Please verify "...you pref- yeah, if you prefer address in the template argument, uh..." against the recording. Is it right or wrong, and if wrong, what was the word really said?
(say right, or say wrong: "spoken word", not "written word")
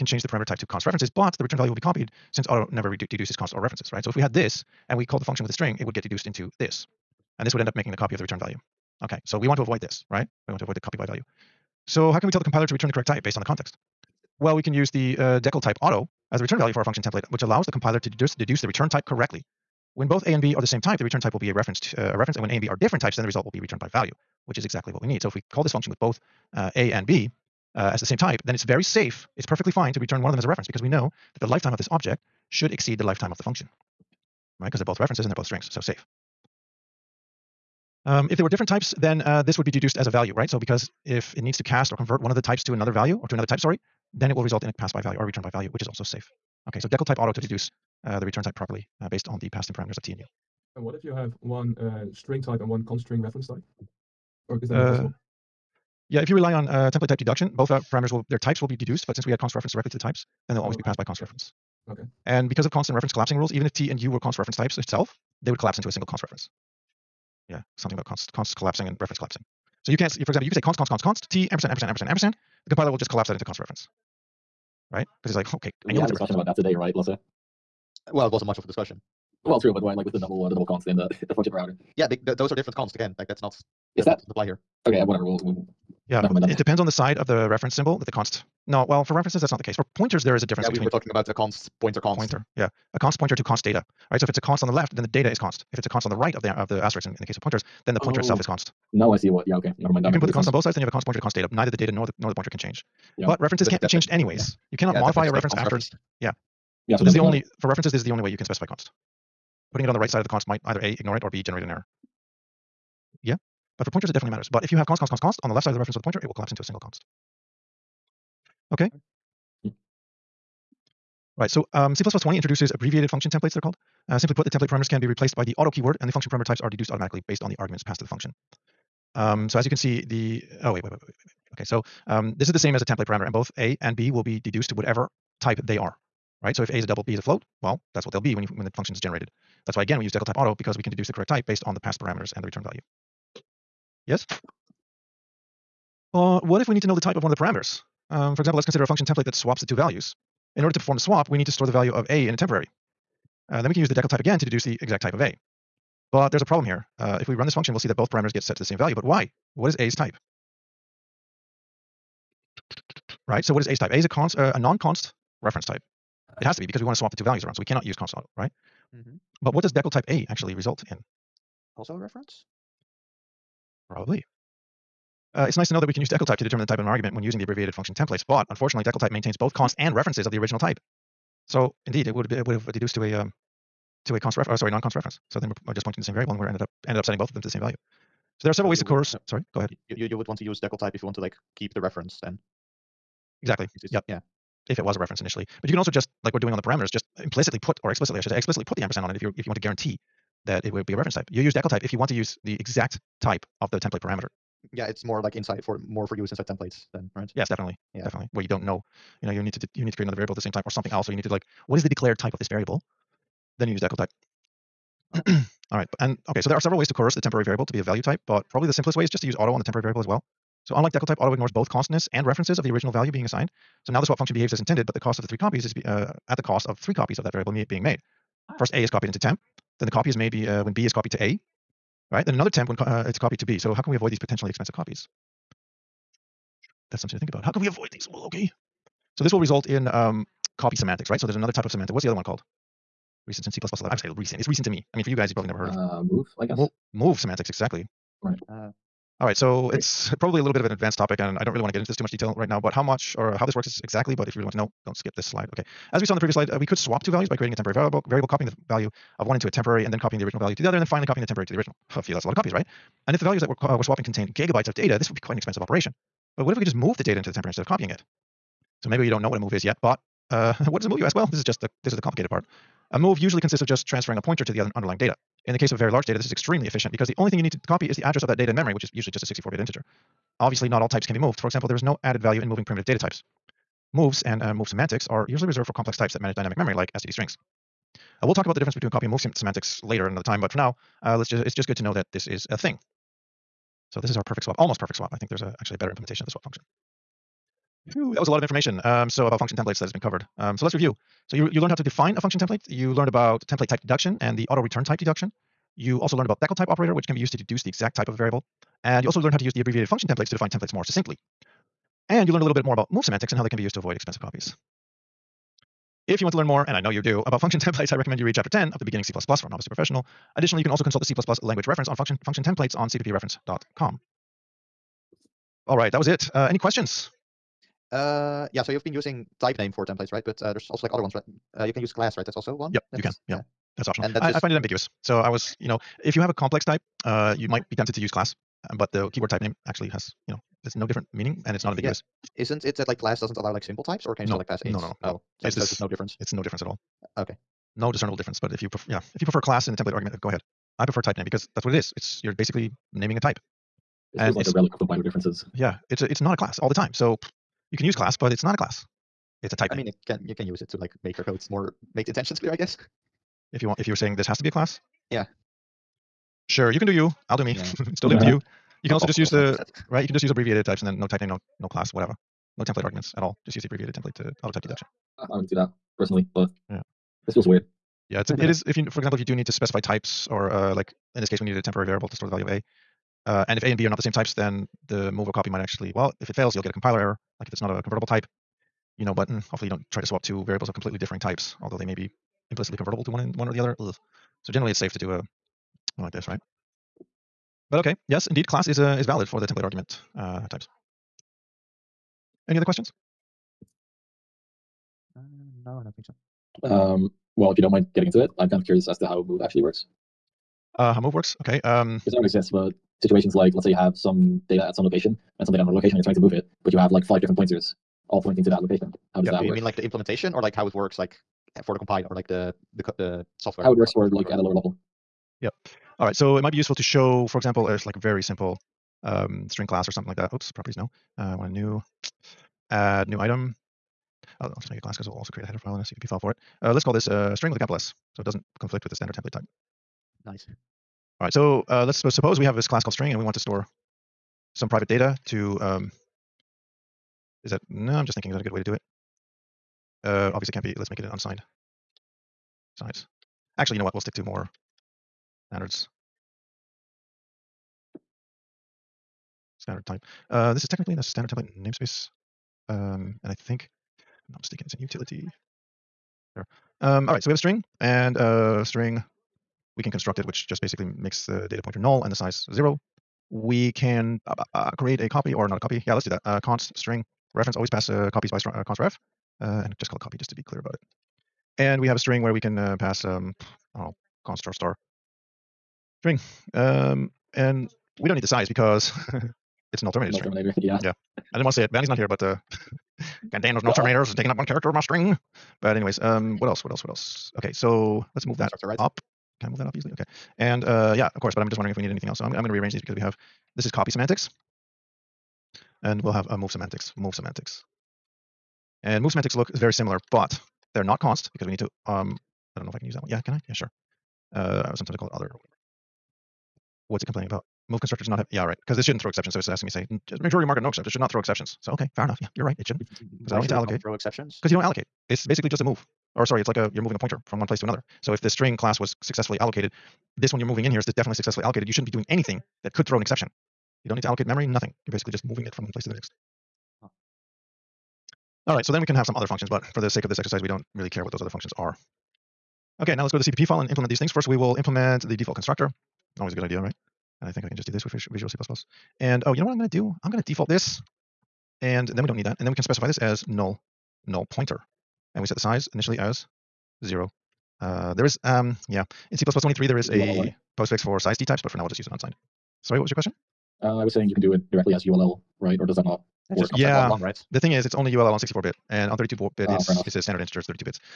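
wrong: "class", not "address".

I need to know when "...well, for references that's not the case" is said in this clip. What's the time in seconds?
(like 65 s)
88 s.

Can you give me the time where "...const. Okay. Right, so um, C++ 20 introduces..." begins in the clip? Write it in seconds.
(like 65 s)
116 s.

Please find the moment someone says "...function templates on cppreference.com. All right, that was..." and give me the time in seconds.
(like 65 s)
322 s.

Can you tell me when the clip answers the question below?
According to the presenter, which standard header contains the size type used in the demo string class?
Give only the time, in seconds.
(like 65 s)
464 s.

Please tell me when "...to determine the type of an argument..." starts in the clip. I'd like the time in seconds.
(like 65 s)
176 s.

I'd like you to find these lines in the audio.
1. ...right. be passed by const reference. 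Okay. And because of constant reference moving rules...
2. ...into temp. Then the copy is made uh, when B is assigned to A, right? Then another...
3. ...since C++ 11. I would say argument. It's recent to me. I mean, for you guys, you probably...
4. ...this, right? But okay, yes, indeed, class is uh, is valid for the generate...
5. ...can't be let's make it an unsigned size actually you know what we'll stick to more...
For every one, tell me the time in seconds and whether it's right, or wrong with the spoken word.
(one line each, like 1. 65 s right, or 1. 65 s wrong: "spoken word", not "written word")
1. 60 s wrong: "collapsing", not "moving"
2. 229 s wrong: "copied", not "assigned"
3. 243 s wrong: "recent", not "argument"
4. 396 s wrong: "template", not "generate"
5. 450 s right.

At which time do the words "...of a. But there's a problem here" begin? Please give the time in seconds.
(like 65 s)
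155 s.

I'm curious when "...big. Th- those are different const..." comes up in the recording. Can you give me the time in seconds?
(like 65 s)
82 s.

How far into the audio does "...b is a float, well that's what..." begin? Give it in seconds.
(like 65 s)
137 s.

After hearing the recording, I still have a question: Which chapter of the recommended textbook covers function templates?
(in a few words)
Chapter 10.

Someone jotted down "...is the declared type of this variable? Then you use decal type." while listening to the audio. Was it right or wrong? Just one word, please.
right.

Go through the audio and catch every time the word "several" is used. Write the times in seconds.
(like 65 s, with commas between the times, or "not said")
188 s, 216 s.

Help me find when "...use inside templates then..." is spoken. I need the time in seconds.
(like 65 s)
206 s.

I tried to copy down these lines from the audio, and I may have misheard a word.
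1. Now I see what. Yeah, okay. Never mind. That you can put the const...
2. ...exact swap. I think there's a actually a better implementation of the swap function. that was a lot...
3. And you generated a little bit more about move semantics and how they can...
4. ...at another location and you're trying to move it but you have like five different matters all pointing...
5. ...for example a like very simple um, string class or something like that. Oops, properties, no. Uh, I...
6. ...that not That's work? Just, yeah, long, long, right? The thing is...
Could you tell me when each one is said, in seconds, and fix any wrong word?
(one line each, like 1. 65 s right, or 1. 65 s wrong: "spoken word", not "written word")
1. 98 s right
2. 294 s wrong: "perfect", not "exact"
3. 312 s wrong: "learned", not "generated"
4. 415 s wrong: "pointers", not "matters"
5. 427 s right
6. 565 s right.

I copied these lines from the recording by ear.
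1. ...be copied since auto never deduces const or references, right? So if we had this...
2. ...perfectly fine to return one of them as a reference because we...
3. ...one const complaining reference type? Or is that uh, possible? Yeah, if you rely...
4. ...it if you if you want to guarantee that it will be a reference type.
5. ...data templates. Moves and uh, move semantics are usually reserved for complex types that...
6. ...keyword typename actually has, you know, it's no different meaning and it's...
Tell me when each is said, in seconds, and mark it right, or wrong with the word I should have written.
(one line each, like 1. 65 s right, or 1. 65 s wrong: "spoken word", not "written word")
1. 1 s right
2. 29 s right
3. 52 s wrong: "string", not "complaining"
4. 199 s right
5. 282 s wrong: "types", not "templates"
6. 339 s right.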